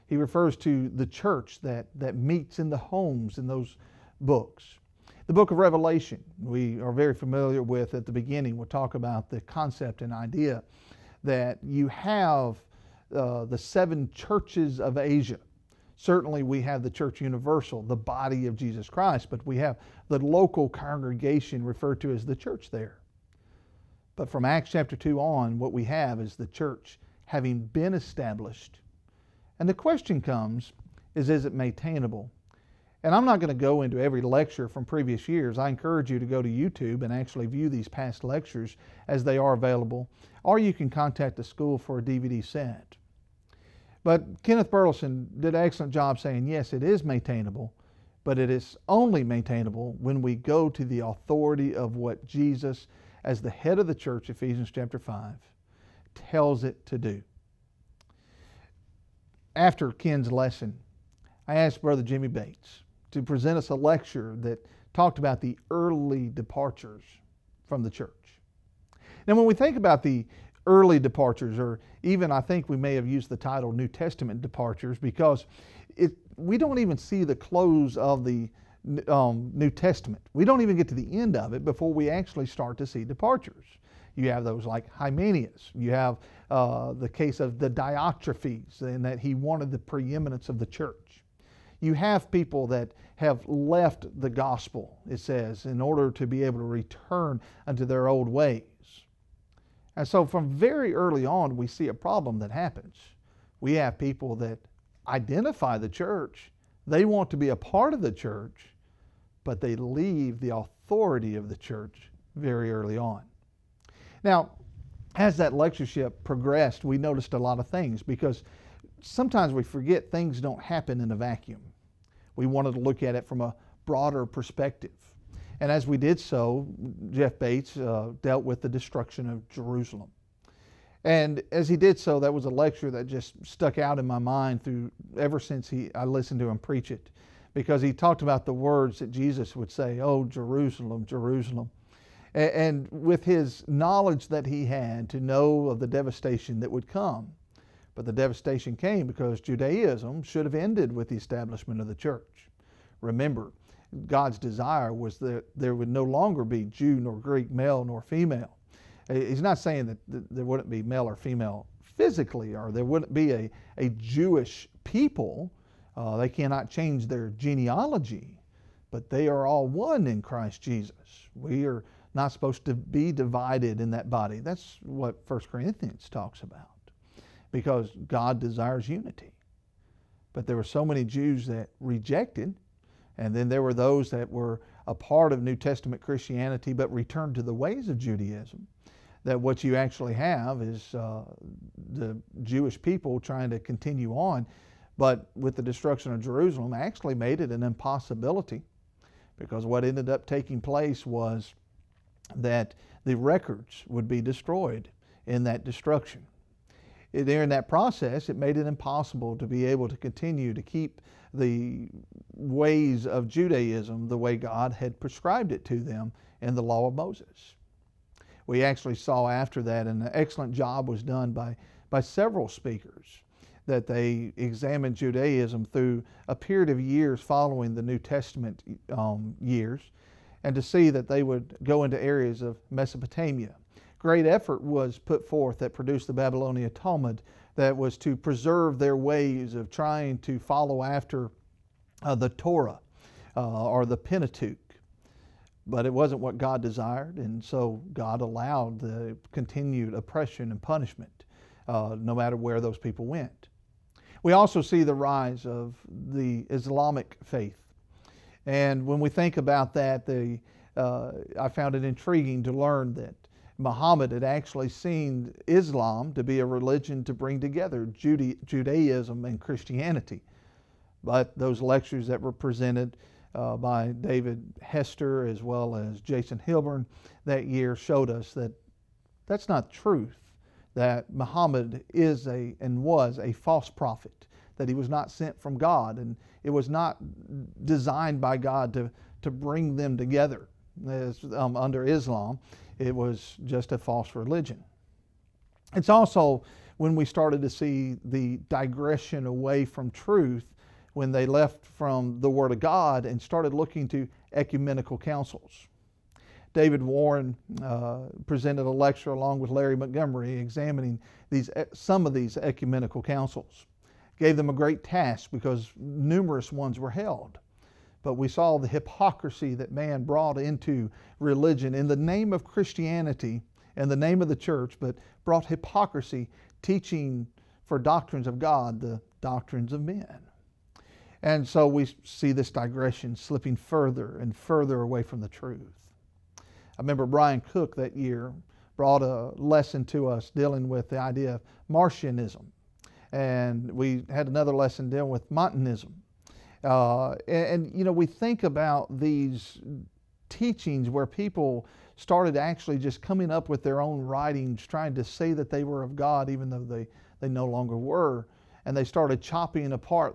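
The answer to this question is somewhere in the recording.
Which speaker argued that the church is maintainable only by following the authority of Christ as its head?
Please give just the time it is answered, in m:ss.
0:44.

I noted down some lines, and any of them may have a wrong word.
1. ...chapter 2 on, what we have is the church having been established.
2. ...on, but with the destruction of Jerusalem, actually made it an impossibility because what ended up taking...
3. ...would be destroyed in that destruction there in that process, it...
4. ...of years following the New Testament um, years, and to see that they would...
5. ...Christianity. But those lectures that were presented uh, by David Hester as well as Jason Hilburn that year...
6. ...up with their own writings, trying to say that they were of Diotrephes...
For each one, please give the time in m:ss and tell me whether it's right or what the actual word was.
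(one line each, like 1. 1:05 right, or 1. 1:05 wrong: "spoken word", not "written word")
1. 0:24 right
2. 3:14 right
3. 3:23 right
4. 3:46 right
5. 4:29 right
6. 5:53 wrong: "God", not "Diotrephes".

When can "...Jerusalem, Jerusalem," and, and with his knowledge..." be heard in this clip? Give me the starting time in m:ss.
2:20.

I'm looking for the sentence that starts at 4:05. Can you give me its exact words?
But it wasn't what God desired, and so God allowed the continued oppression and punishment uh, no matter where those people went.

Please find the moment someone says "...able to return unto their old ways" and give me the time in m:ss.
1:36.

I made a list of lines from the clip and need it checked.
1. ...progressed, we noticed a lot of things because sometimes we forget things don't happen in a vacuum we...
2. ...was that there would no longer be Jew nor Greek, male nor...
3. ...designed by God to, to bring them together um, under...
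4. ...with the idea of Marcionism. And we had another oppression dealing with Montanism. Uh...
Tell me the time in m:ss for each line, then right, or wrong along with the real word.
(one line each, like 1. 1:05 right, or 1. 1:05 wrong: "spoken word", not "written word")
1. 1:56 right
2. 2:34 right
3. 4:47 right
4. 5:40 wrong: "lesson", not "oppression".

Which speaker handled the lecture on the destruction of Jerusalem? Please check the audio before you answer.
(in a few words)
Jeff Bates.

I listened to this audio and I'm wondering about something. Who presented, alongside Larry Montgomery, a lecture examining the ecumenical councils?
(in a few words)
David Warren.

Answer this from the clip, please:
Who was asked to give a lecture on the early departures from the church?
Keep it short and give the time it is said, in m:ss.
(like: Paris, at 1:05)
Jimmy Bates, at 1:02.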